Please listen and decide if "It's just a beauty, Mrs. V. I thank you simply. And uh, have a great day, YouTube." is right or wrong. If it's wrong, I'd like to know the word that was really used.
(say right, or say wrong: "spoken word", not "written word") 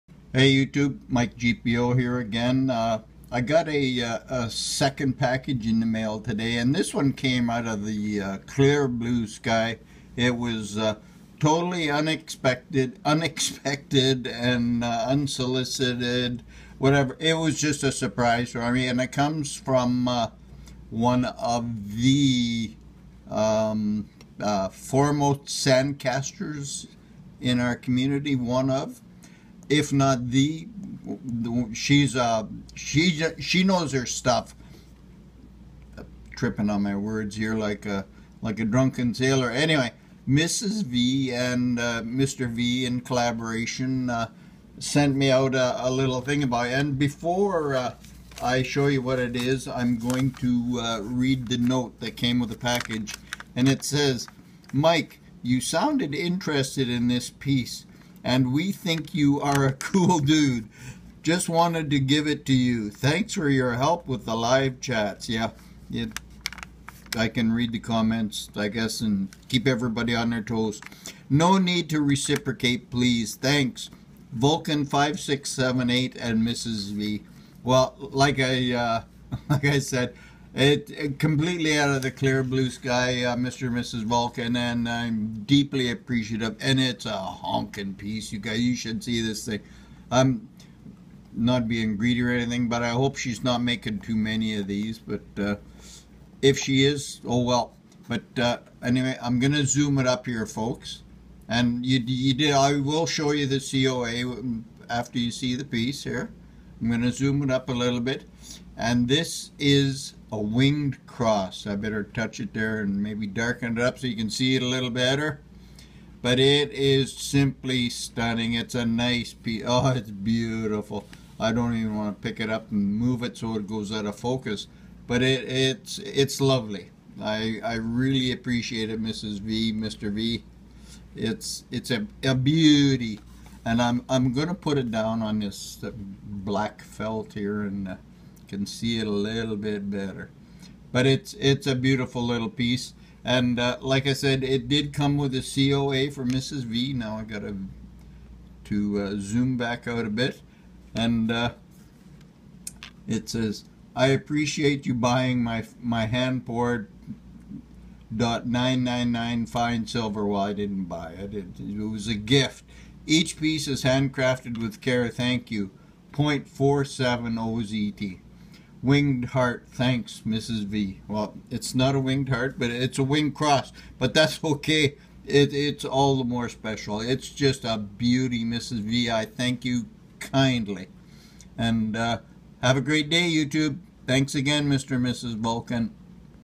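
wrong: "kindly", not "simply".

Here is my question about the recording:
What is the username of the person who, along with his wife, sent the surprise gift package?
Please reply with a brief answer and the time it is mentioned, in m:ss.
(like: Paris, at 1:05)
Vulcan5678, at 1:14.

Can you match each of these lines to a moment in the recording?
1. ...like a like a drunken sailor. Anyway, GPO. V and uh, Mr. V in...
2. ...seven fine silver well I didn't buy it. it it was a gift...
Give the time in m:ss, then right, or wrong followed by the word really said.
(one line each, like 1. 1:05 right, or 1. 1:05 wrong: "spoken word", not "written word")
1. 0:37 wrong: "Mrs", not "GPO"
2. 2:39 wrong: "nine", not "seven".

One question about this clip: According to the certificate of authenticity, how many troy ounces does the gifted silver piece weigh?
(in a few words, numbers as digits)
0.47 ozt.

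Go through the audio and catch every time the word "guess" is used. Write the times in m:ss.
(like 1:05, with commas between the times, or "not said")
1:08.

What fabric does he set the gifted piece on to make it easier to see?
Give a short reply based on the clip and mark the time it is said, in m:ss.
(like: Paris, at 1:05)
black felt, at 2:16.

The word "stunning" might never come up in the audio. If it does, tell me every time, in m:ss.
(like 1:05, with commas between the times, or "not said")
1:57.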